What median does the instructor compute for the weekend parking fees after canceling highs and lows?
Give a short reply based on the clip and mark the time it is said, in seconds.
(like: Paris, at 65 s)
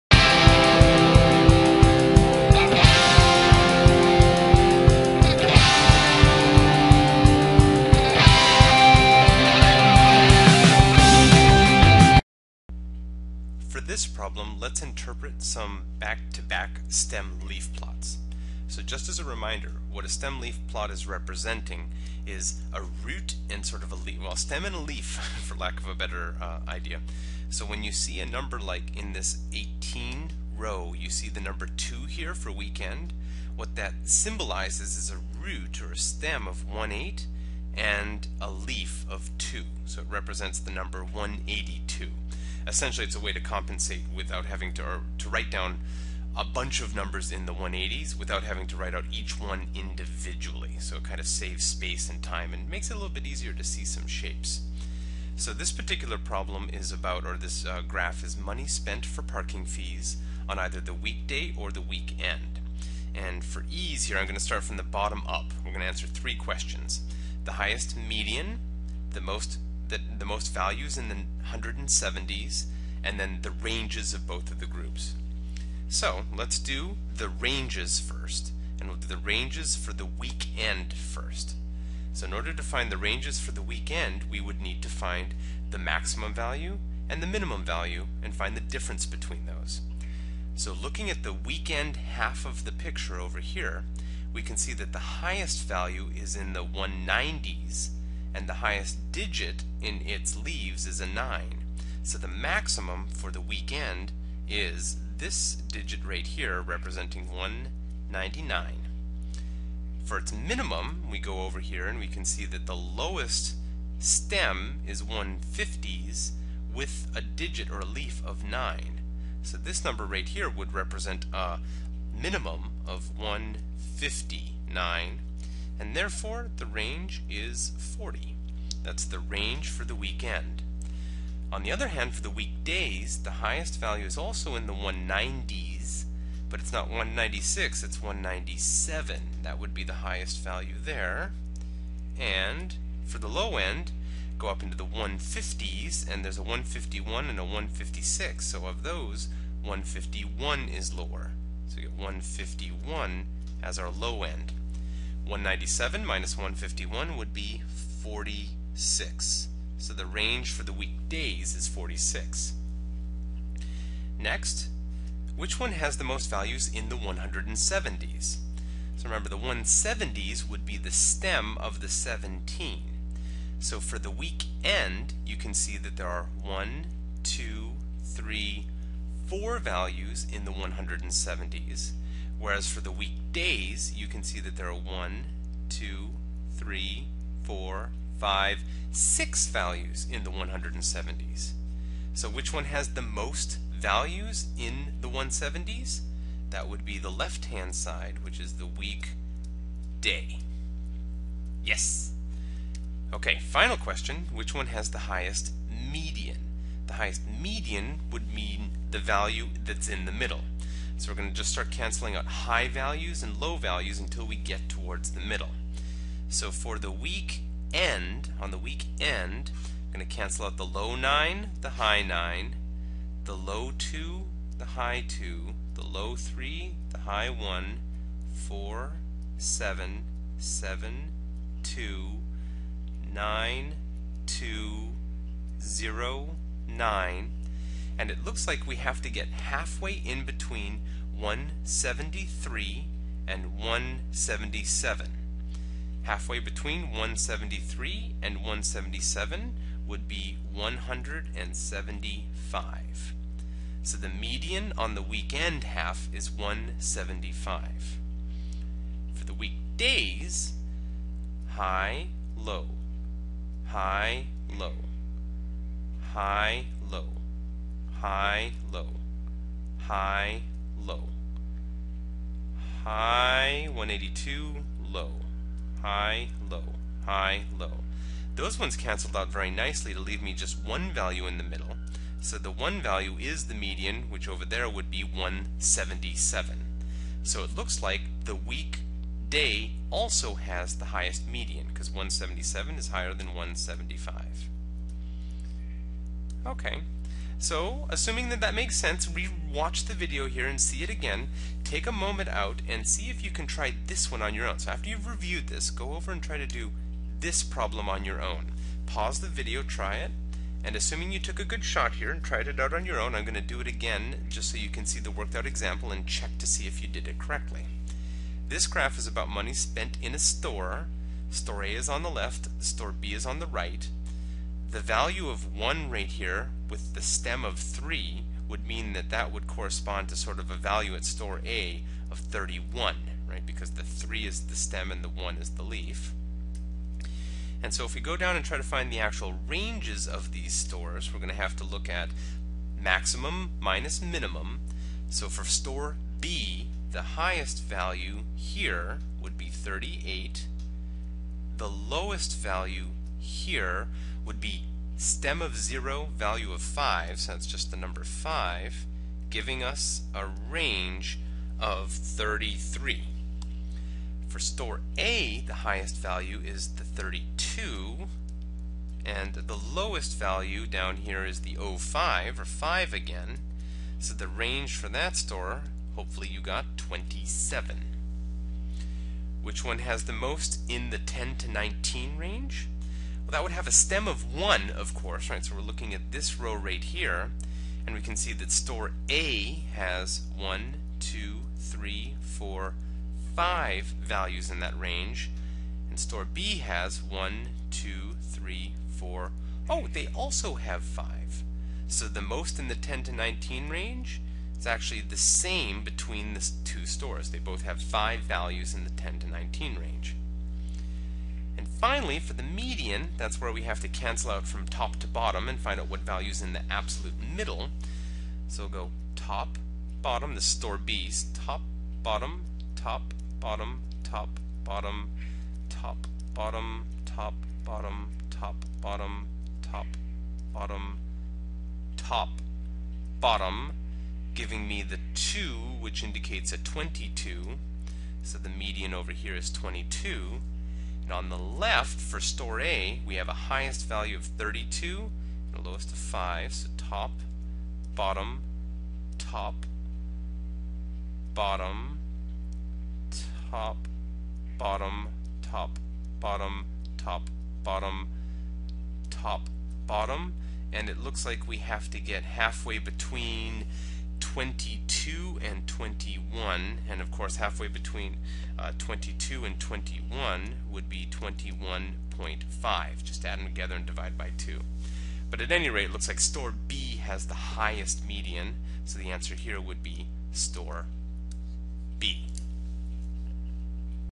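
175, at 253 s.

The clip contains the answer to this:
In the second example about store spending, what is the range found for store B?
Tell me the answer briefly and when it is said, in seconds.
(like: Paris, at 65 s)
33, at 360 s.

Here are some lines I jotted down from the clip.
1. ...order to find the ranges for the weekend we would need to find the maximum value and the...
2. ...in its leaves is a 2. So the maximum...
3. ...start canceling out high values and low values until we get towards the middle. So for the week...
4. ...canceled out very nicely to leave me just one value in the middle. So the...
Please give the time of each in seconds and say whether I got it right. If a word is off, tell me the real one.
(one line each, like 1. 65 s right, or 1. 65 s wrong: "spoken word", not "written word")
1. 82 s right
2. 99 s wrong: "9", not "2"
3. 211 s right
4. 278 s right.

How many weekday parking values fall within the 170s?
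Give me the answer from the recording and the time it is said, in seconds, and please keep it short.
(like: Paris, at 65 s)
6, at 188 s.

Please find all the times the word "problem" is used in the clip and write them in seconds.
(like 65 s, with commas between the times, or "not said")
14 s, 56 s, 307 s.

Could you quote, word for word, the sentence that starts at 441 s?
And on the left, for store A, we have a highest value of 32 and a lowest of 5.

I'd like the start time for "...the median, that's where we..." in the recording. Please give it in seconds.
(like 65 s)
412 s.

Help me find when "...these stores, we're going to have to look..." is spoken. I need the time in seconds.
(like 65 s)
340 s.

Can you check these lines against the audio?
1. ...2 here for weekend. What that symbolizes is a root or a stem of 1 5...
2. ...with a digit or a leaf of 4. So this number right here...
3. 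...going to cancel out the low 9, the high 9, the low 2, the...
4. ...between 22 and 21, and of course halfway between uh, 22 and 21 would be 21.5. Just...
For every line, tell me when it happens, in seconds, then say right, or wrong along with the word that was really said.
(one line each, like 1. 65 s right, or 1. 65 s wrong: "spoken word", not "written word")
1. 31 s wrong: "8", not "5"
2. 116 s wrong: "9", not "4"
3. 219 s right
4. 462 s right.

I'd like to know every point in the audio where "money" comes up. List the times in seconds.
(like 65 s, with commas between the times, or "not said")
58 s, 319 s.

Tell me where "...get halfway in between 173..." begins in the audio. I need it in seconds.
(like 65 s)
239 s.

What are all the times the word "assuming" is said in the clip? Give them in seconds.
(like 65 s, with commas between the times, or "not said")
297 s, 310 s.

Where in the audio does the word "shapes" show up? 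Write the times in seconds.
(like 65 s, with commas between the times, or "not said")
54 s.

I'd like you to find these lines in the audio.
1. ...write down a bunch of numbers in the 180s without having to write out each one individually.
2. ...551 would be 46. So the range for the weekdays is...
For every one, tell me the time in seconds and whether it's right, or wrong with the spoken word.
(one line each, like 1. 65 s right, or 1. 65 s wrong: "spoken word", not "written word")
1. 45 s right
2. 156 s wrong: "151", not "551".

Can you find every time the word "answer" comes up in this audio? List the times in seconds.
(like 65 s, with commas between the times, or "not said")
65 s, 479 s.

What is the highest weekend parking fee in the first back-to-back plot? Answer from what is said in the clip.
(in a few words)
199.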